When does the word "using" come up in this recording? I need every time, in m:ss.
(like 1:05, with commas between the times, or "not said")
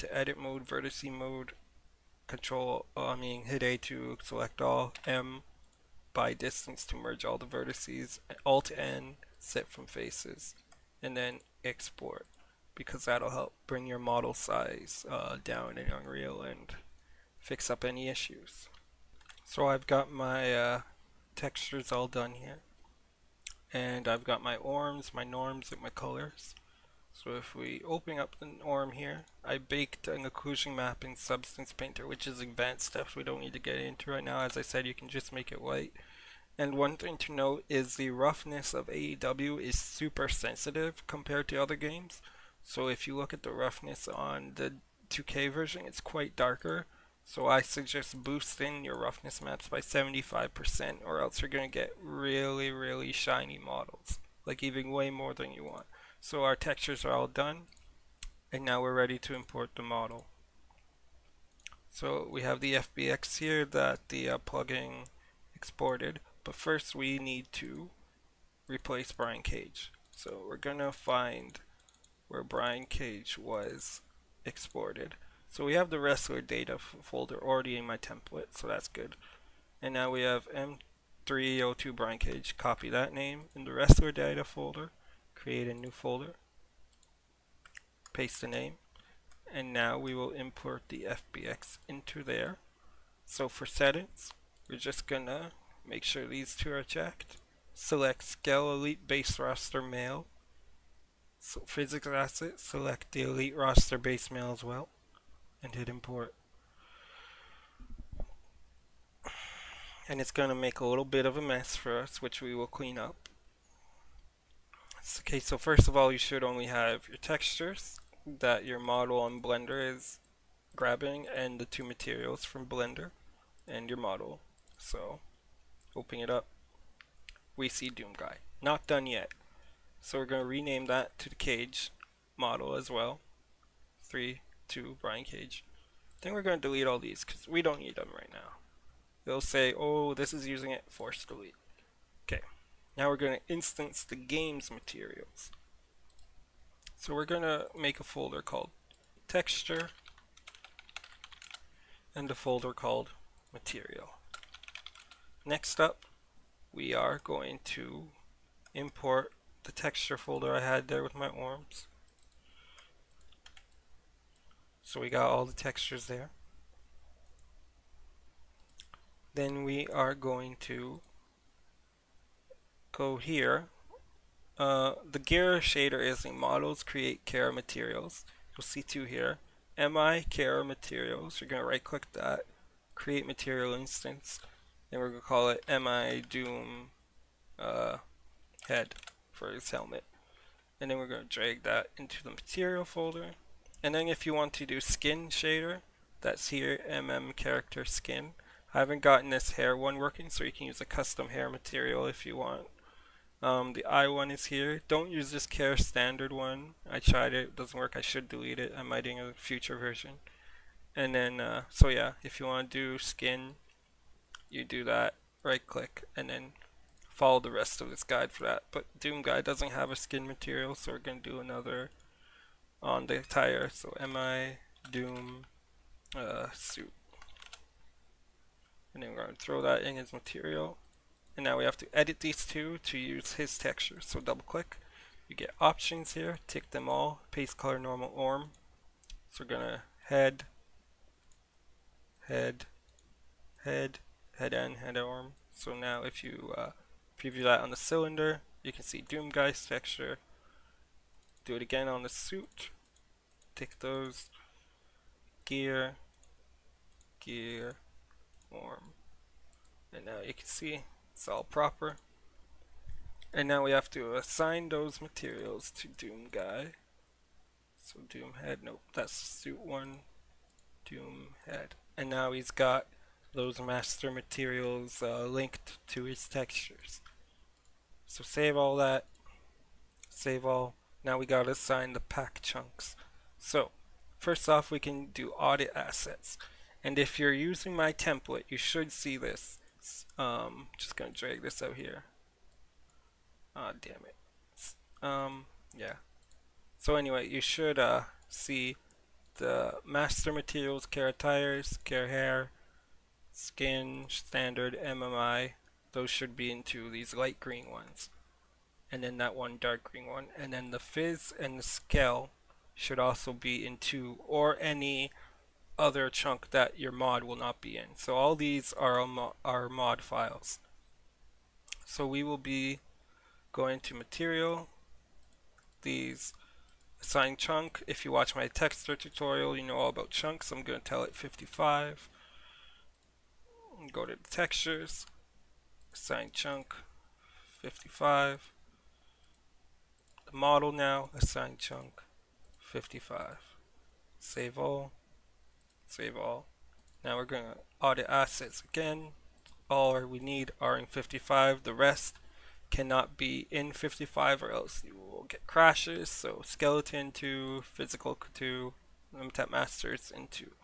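2:20, 4:47.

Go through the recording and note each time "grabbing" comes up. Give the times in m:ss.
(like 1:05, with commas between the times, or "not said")
2:00.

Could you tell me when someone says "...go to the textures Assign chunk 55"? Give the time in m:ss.
5:33.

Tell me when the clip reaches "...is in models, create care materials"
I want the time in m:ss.
2:56.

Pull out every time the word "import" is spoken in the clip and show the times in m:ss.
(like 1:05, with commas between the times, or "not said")
0:59, 1:30, 1:45, 2:38.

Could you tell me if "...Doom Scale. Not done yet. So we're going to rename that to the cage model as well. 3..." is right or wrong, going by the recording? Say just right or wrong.
wrong.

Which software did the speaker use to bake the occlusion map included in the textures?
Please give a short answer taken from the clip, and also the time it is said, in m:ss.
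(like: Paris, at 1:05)
Substance Painter, at 0:31.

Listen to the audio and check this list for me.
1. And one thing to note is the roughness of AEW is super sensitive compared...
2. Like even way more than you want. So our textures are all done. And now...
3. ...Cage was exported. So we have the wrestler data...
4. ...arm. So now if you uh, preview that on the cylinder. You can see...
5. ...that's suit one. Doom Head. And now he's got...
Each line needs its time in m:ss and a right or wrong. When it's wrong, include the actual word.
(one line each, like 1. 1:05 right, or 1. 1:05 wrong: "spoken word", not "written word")
1. 0:36 right
2. 0:54 right
3. 1:12 right
4. 4:04 right
5. 4:28 right.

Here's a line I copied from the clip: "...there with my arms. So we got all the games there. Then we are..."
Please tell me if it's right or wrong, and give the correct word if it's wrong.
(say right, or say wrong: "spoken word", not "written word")
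wrong: "textures", not "games".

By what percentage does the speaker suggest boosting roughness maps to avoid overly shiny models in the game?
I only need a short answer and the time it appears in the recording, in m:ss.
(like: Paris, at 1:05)
75%, at 0:49.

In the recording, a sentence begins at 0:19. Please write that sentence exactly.
So I've got my uh, textures all done here and I've got my orms, my norms, and my colors.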